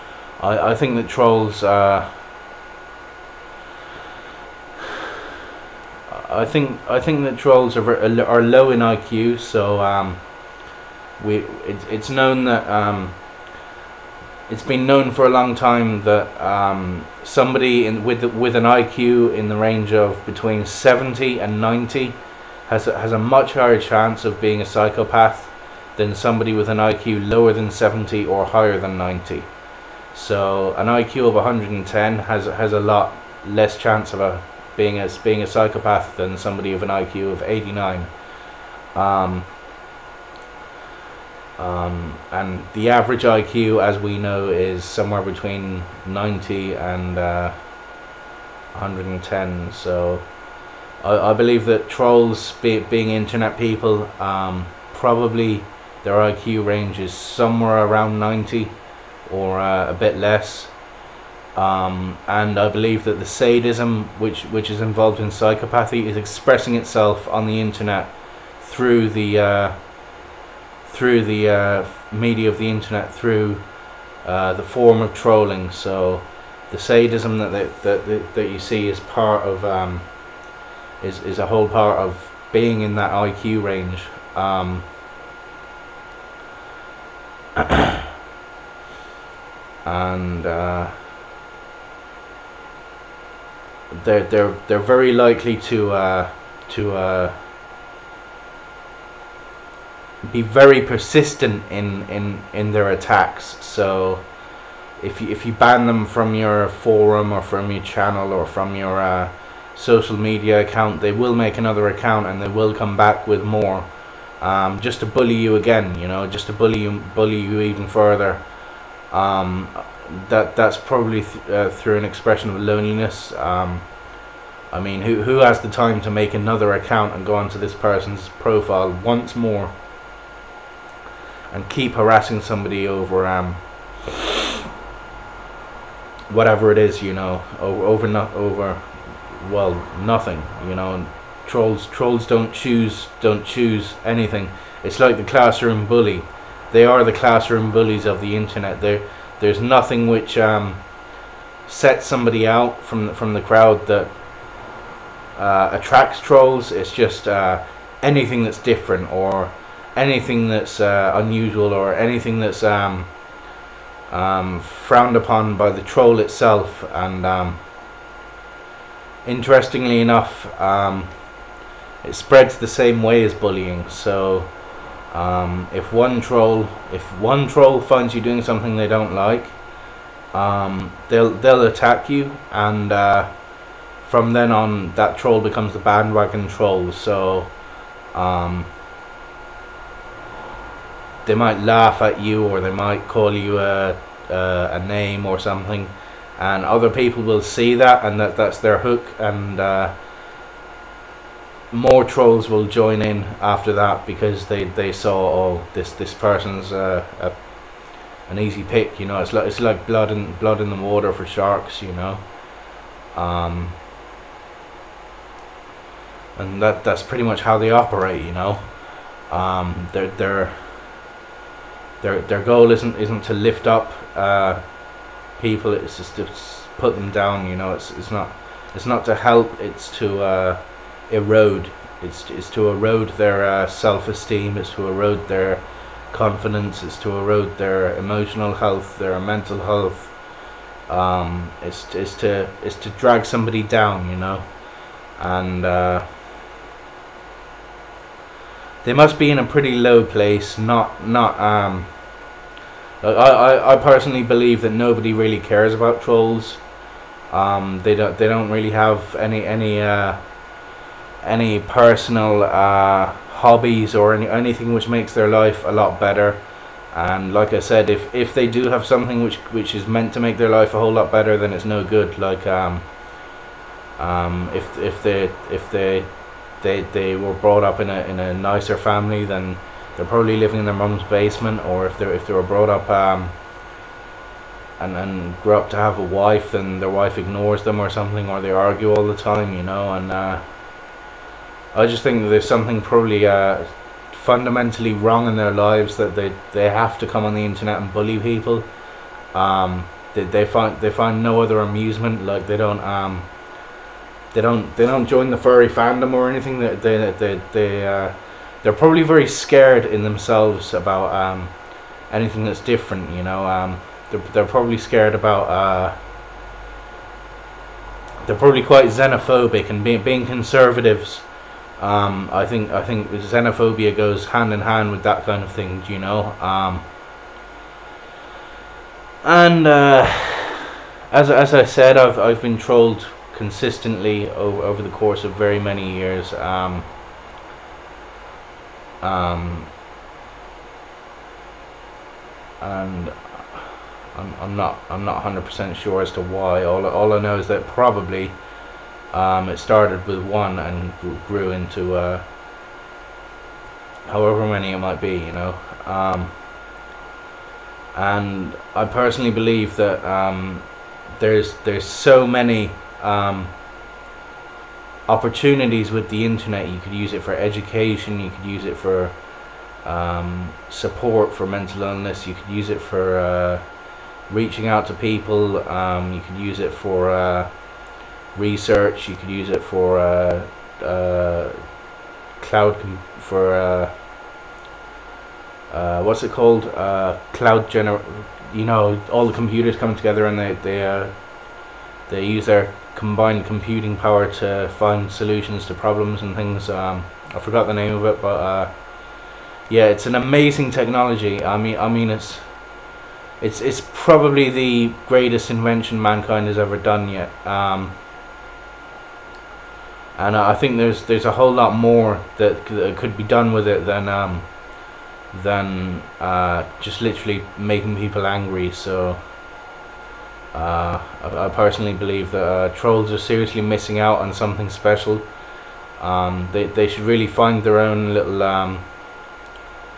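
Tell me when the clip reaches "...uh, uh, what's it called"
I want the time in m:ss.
6:23.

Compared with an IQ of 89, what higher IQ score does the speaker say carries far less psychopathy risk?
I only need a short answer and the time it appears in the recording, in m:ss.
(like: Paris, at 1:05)
110, at 0:30.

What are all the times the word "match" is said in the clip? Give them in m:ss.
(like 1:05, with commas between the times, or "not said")
not said.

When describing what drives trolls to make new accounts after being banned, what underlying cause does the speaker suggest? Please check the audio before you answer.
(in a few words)
loneliness.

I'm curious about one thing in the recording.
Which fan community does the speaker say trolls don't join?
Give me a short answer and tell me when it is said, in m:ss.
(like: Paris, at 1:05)
furry fandom, at 5:05.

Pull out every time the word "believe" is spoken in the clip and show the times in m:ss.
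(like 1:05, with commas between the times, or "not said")
0:51, 1:02, 4:14, 5:59, 7:01.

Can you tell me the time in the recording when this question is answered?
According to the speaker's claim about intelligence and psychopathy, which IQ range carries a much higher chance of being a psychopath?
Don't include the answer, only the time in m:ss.
0:20.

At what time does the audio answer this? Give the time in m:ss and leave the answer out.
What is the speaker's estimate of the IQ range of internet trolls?
0:57.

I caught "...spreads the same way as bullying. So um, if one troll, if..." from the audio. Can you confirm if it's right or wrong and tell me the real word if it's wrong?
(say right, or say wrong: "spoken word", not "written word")
right.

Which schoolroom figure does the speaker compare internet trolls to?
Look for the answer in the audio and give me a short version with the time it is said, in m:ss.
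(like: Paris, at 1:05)
classroom bully, at 2:27.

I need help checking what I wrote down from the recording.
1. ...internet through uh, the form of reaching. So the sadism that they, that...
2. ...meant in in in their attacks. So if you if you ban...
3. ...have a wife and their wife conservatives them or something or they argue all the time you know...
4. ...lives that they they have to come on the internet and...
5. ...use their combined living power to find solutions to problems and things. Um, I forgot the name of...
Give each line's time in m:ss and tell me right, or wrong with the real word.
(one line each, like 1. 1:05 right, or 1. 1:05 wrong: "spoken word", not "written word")
1. 1:12 wrong: "trolling", not "reaching"
2. 1:40 wrong: "persistent", not "meant"
3. 4:45 wrong: "ignores", not "conservatives"
4. 4:55 right
5. 6:32 wrong: "computing", not "living".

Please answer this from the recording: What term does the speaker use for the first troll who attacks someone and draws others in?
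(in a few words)
bandwagon troll.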